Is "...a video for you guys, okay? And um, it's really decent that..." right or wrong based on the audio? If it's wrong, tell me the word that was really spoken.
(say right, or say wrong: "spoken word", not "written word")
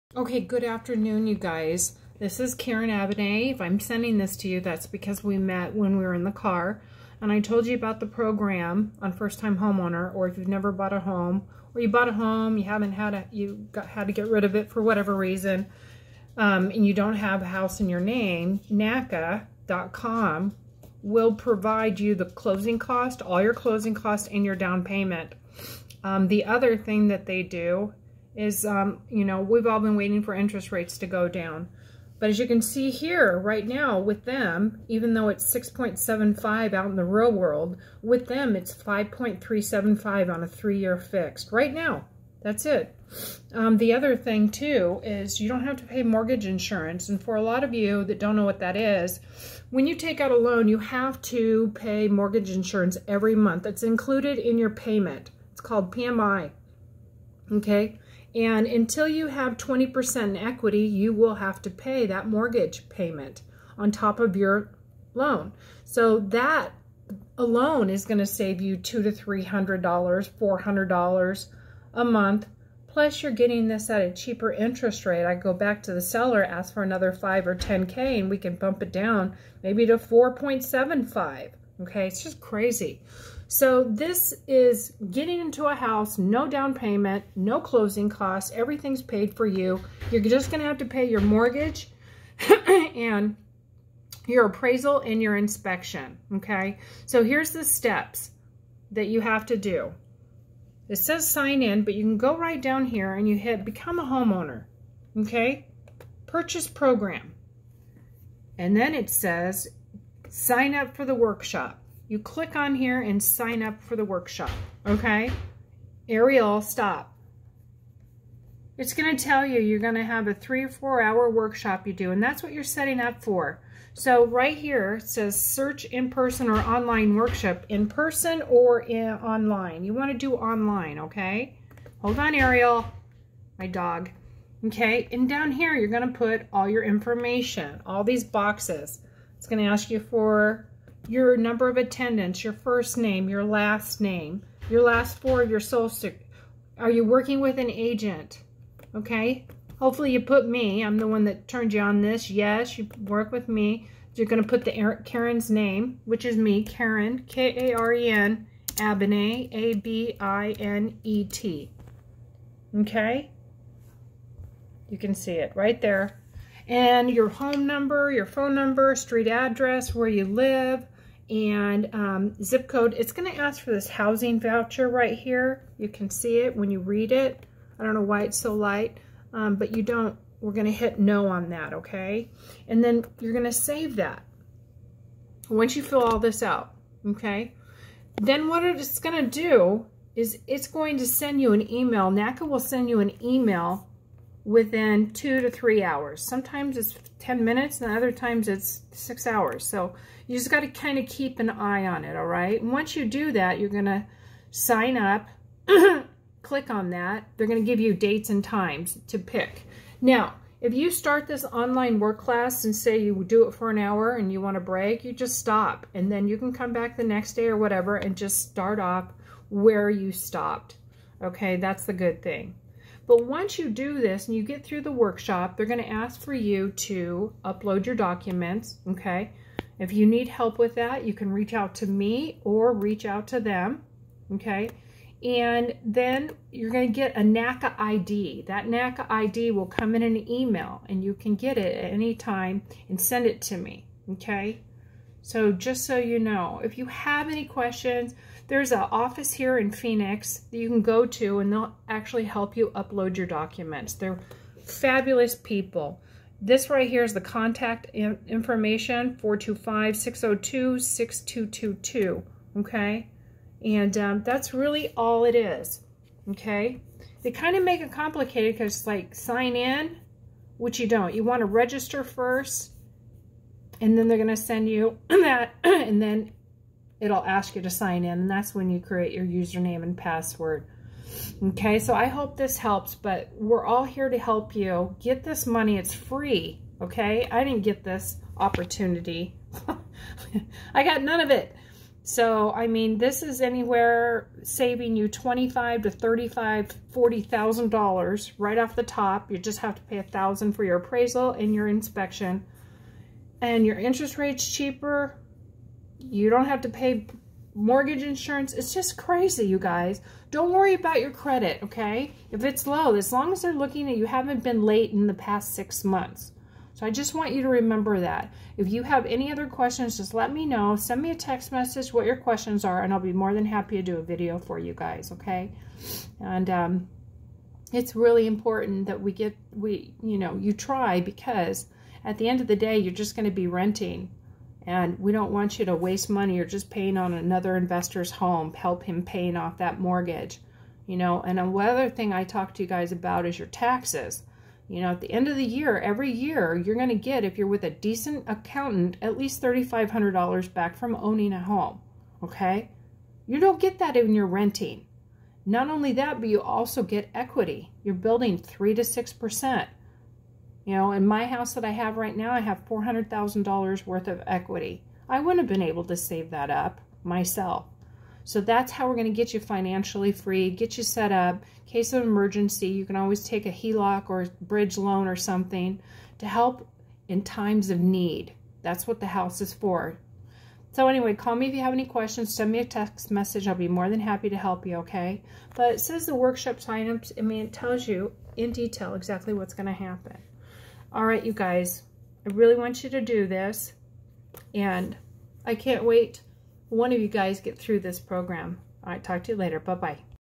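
wrong: "important", not "decent".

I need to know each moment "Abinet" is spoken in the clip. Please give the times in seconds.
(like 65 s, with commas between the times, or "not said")
2 s, 158 s.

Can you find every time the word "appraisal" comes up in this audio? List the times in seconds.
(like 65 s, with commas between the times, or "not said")
94 s, 300 s.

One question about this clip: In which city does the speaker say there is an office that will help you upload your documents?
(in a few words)
Phoenix.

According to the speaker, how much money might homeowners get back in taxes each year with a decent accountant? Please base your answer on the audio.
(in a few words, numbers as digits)
$3,500.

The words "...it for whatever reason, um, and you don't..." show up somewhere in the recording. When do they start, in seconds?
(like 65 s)
14 s.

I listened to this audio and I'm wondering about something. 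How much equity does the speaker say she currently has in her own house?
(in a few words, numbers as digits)
$400,000.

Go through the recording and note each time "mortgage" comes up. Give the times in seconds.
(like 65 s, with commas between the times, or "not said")
46 s, 52 s, 62 s, 91 s, 307 s, 339 s.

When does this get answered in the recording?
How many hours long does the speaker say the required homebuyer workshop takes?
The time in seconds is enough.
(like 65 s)
120 s.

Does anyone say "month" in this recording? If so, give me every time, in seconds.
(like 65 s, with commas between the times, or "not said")
53 s, 72 s, 315 s.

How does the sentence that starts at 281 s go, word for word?
Okay, so I hope this helps, but we're all here to help you.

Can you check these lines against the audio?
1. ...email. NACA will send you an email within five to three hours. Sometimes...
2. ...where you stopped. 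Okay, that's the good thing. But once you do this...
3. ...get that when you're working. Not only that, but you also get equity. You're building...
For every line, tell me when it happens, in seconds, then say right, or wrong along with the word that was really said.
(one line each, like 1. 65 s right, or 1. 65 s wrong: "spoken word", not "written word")
1. 191 s wrong: "two", not "five"
2. 219 s right
3. 353 s wrong: "renting", not "working".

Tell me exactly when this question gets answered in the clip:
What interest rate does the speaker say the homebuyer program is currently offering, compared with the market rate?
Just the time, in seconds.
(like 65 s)
38 s.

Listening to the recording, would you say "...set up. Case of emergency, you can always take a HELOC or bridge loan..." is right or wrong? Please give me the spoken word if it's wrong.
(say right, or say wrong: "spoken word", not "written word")
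right.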